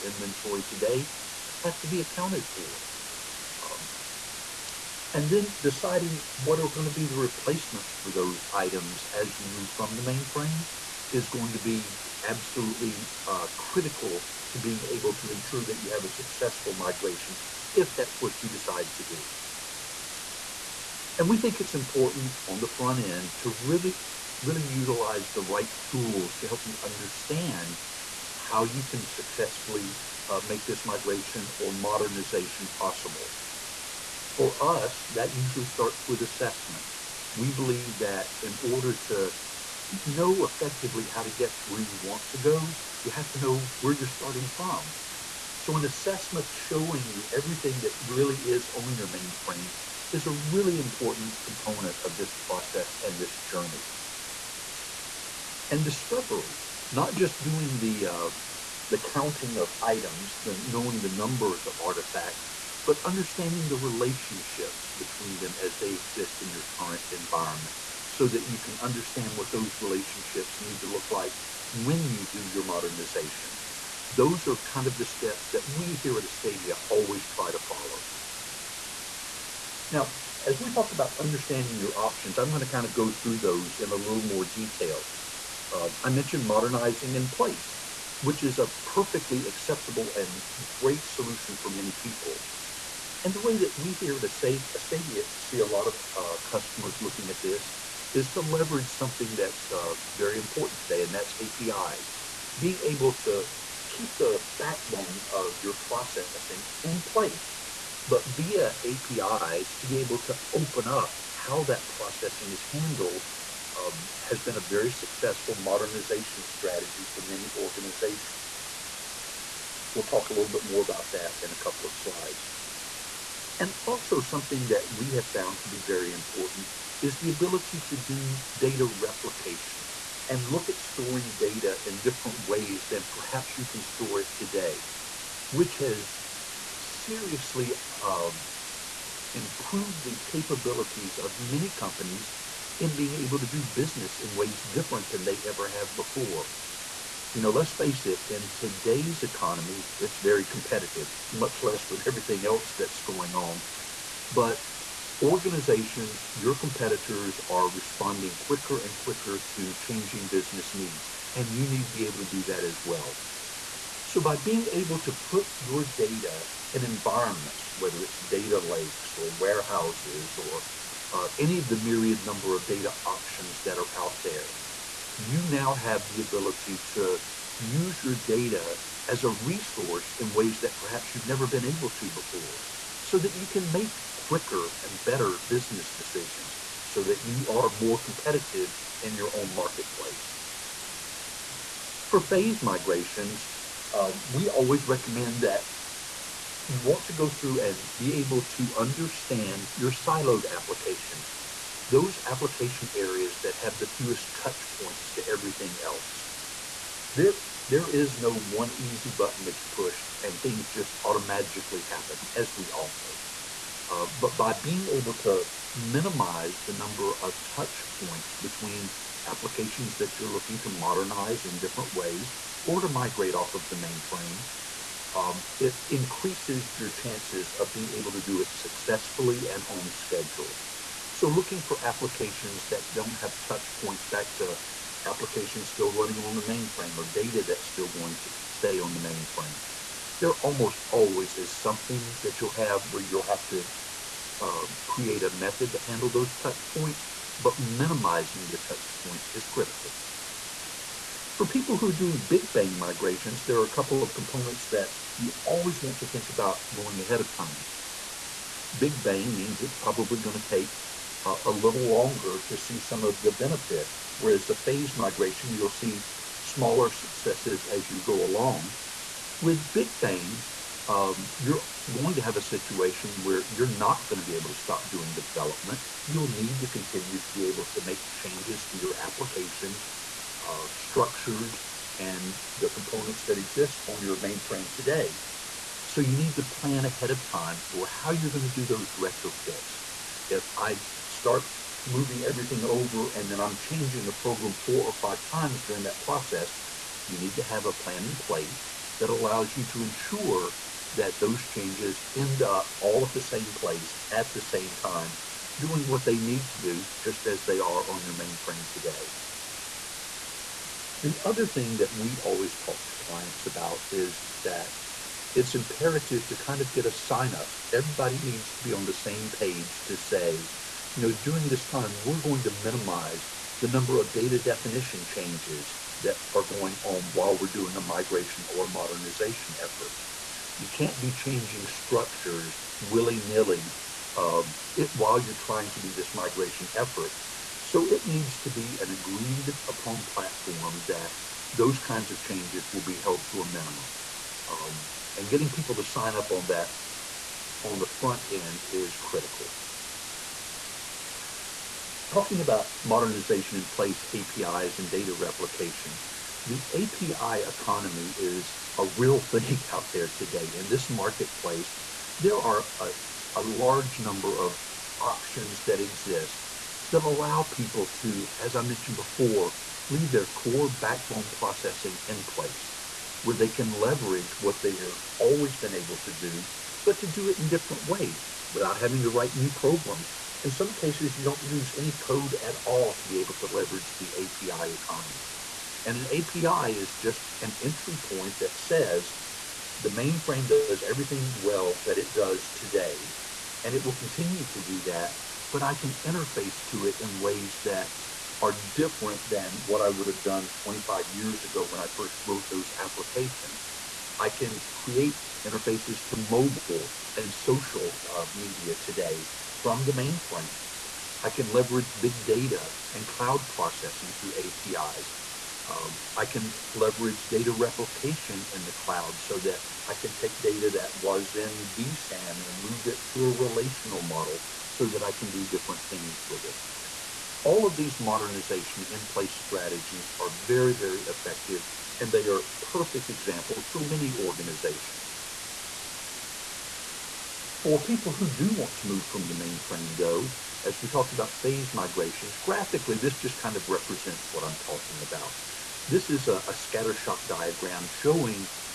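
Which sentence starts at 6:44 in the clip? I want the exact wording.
I can create interfaces to mobile and social uh, media today from the mainframe.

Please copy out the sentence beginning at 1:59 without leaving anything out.
We'll talk a little bit more about that in a couple of slides.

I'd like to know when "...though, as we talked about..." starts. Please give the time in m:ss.
7:19.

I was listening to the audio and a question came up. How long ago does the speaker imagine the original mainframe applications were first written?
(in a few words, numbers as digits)
25 years.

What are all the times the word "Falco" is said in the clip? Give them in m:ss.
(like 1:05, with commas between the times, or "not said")
not said.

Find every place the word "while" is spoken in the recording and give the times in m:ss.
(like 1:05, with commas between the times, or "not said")
5:27, 5:34.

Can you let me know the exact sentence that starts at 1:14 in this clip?
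Those are kind of the steps that we here at Astadia always try to follow.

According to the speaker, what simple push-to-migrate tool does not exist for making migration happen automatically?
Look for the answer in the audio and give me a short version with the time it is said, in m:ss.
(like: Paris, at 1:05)
Easy button, at 3:28.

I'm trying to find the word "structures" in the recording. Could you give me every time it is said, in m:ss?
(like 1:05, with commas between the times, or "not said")
4:40, 5:31.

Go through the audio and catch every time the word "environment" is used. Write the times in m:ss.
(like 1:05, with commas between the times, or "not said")
1:07, 2:46.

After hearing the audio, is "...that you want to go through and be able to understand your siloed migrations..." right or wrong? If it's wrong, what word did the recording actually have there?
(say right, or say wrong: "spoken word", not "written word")
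wrong: "applications", not "migrations".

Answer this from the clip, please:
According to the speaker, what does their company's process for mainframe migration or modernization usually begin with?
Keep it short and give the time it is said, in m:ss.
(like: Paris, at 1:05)
Assessments, at 0:36.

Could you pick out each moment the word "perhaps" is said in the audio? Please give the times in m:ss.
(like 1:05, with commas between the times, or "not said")
2:13, 3:00.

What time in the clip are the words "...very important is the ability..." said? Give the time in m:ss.
2:05.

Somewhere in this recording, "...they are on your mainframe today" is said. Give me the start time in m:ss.
5:07.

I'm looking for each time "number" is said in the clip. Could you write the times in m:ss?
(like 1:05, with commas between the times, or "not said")
1:01, 2:52, 3:36, 5:23, 6:03.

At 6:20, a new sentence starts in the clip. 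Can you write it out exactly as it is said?
In some cases, you don't use any code at all to be able to leverage the API economy.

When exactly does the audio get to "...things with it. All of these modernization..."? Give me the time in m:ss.
7:05.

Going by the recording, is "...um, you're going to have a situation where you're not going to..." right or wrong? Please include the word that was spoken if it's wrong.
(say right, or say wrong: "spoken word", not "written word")
right.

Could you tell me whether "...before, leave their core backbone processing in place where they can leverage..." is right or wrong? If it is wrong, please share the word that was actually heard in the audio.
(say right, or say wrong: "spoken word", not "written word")
right.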